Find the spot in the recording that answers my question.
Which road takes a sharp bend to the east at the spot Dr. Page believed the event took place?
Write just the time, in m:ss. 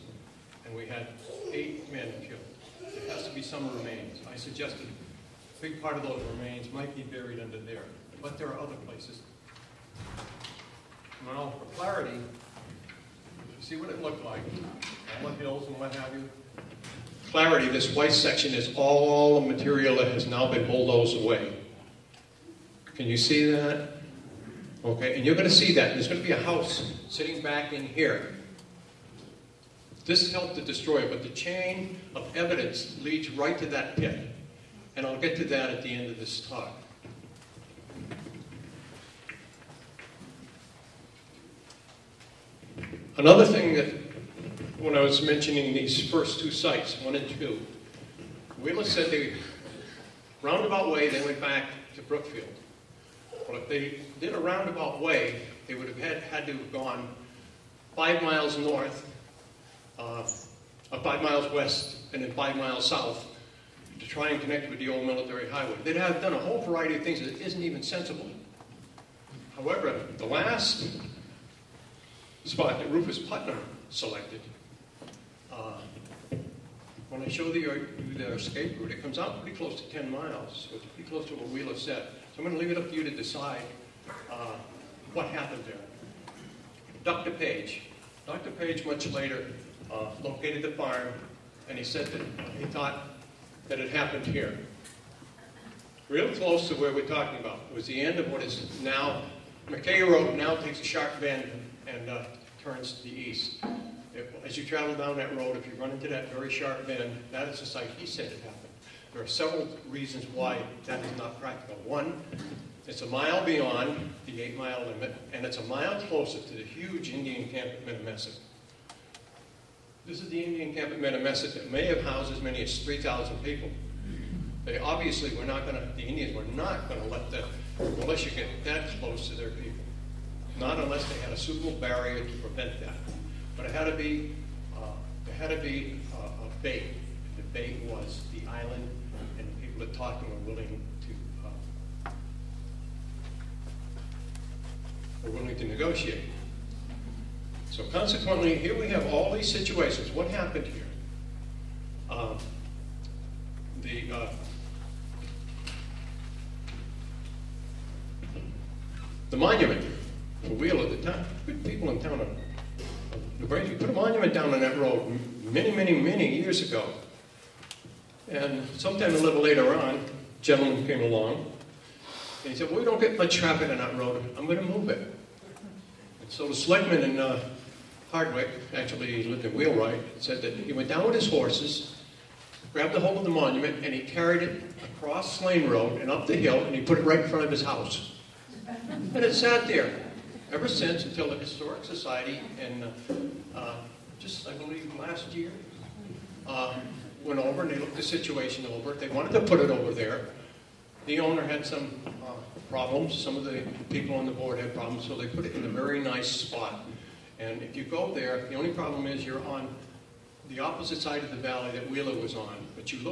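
1:39.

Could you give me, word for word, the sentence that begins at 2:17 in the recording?
And the bait was the island, and the people that talked to were willing to uh, were willing to negotiate.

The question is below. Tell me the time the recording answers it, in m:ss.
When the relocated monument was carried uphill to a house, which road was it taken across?
3:05.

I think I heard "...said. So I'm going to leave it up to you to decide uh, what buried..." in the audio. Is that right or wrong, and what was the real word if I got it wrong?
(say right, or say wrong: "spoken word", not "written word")
wrong: "happened", not "buried".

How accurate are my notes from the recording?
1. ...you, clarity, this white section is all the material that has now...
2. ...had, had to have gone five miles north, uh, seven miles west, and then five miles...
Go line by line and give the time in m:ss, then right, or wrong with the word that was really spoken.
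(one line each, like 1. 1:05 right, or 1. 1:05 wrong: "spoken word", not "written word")
1. 0:16 right
2. 0:55 wrong: "five", not "seven".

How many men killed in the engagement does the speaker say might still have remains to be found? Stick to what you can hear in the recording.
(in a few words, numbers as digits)
8.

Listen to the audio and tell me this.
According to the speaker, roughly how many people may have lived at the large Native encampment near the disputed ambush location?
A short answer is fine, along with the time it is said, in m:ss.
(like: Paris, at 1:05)
3,000, at 2:02.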